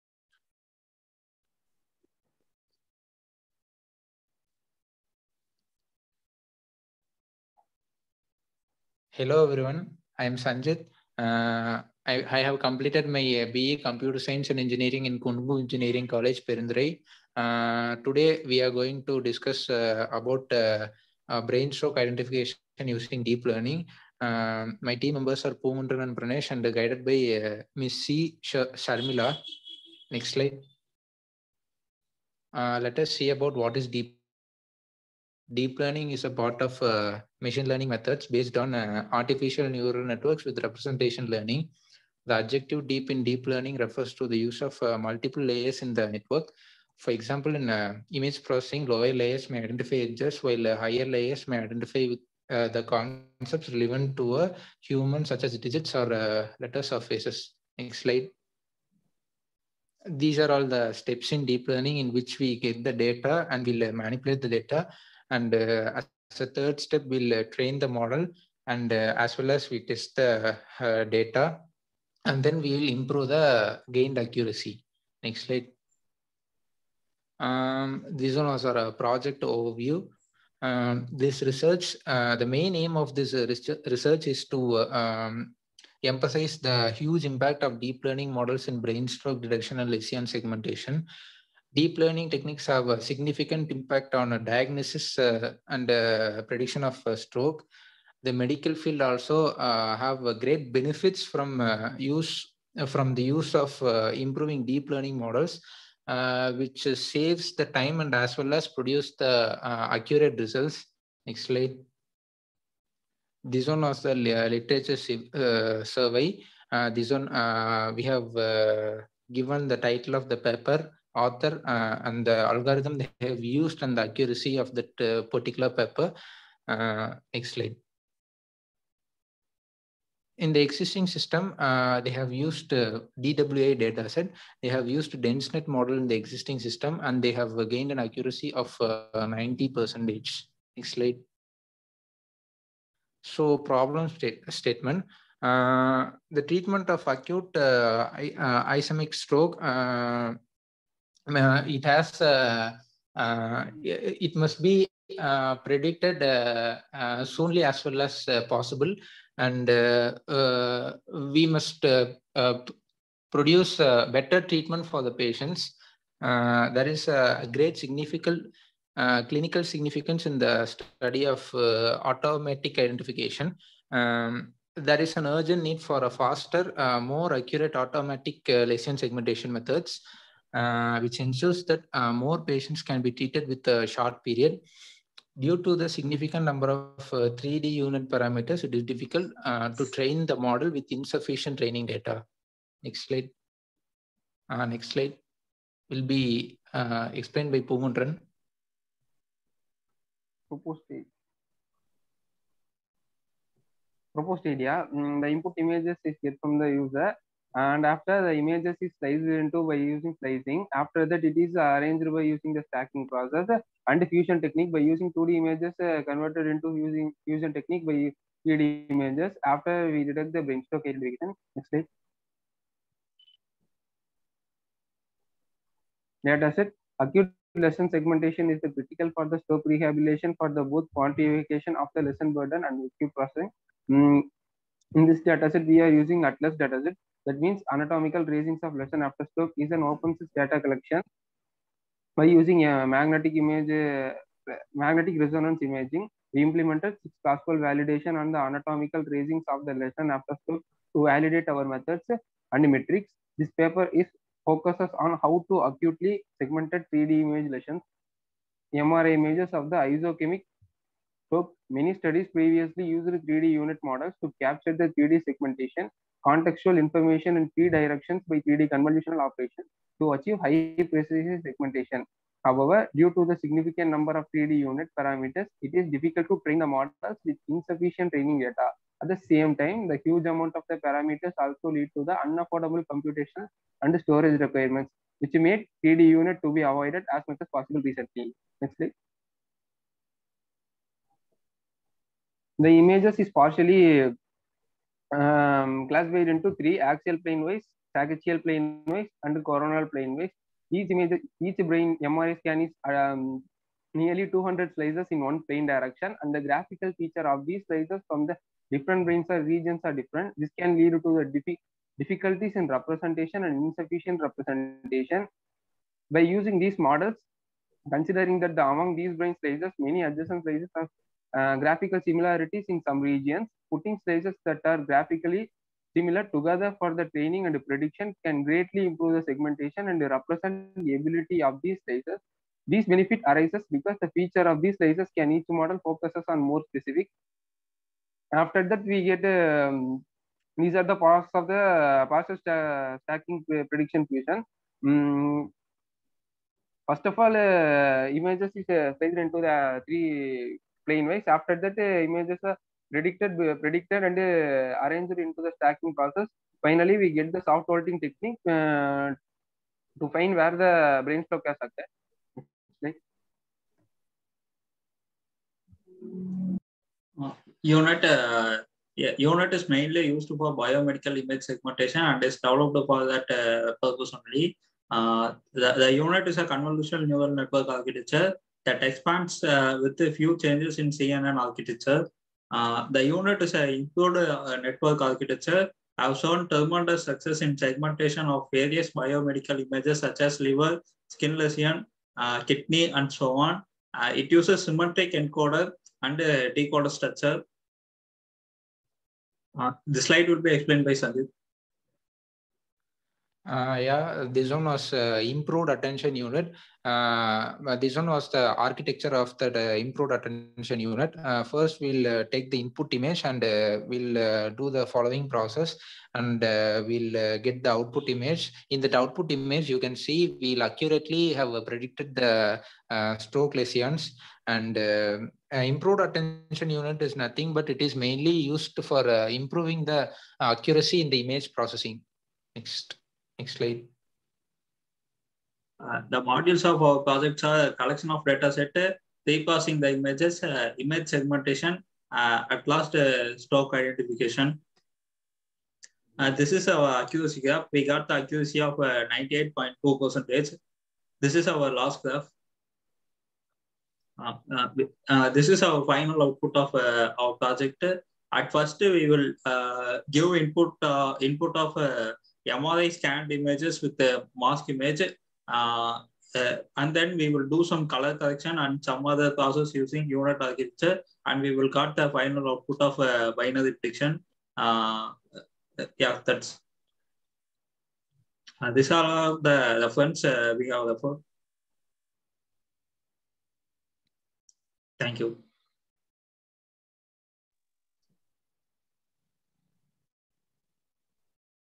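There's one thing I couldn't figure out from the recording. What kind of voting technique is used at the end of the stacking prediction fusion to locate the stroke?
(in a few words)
soft voting.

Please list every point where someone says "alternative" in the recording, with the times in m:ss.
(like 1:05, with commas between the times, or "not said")
not said.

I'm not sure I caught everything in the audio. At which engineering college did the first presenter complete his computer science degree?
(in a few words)
Kongu Engineering College.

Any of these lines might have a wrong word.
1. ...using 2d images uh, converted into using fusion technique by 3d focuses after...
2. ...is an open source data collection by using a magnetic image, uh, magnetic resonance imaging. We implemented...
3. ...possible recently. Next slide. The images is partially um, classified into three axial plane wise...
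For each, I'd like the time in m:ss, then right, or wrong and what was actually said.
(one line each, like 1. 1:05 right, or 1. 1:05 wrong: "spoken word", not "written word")
1. 3:34 wrong: "images", not "focuses"
2. 3:59 right
3. 4:47 right.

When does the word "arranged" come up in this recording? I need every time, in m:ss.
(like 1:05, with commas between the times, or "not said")
3:31, 5:54.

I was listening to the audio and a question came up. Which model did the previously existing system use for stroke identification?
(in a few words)
DenseNet.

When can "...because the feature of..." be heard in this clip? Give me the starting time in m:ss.
5:33.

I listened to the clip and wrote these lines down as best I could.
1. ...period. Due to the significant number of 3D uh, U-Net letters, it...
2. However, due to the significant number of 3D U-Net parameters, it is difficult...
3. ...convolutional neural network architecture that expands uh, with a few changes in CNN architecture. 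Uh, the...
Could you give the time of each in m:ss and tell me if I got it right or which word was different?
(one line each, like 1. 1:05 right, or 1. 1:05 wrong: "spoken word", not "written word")
1. 3:04 wrong: "parameters", not "letters"
2. 4:32 right
3. 6:16 right.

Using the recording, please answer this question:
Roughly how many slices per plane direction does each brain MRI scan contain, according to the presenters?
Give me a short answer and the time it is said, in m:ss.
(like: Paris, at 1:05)
200, at 5:03.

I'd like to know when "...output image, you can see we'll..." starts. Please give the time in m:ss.
6:58.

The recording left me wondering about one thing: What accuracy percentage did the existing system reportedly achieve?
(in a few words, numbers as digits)
90%.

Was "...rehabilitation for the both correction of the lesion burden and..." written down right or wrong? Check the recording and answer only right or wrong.
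wrong.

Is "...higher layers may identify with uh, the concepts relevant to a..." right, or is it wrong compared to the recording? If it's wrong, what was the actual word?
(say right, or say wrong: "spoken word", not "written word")
right.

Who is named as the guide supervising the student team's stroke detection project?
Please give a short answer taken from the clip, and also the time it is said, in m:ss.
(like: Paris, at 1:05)
C. Sharmila, at 0:27.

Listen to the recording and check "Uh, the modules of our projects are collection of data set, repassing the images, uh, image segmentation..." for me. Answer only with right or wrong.
right.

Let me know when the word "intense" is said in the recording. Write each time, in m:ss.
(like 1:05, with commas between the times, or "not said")
not said.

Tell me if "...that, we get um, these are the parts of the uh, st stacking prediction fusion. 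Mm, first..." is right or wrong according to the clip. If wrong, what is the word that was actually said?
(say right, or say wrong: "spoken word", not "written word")
right.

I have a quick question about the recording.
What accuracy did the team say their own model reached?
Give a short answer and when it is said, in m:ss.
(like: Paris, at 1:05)
98.2%, at 7:29.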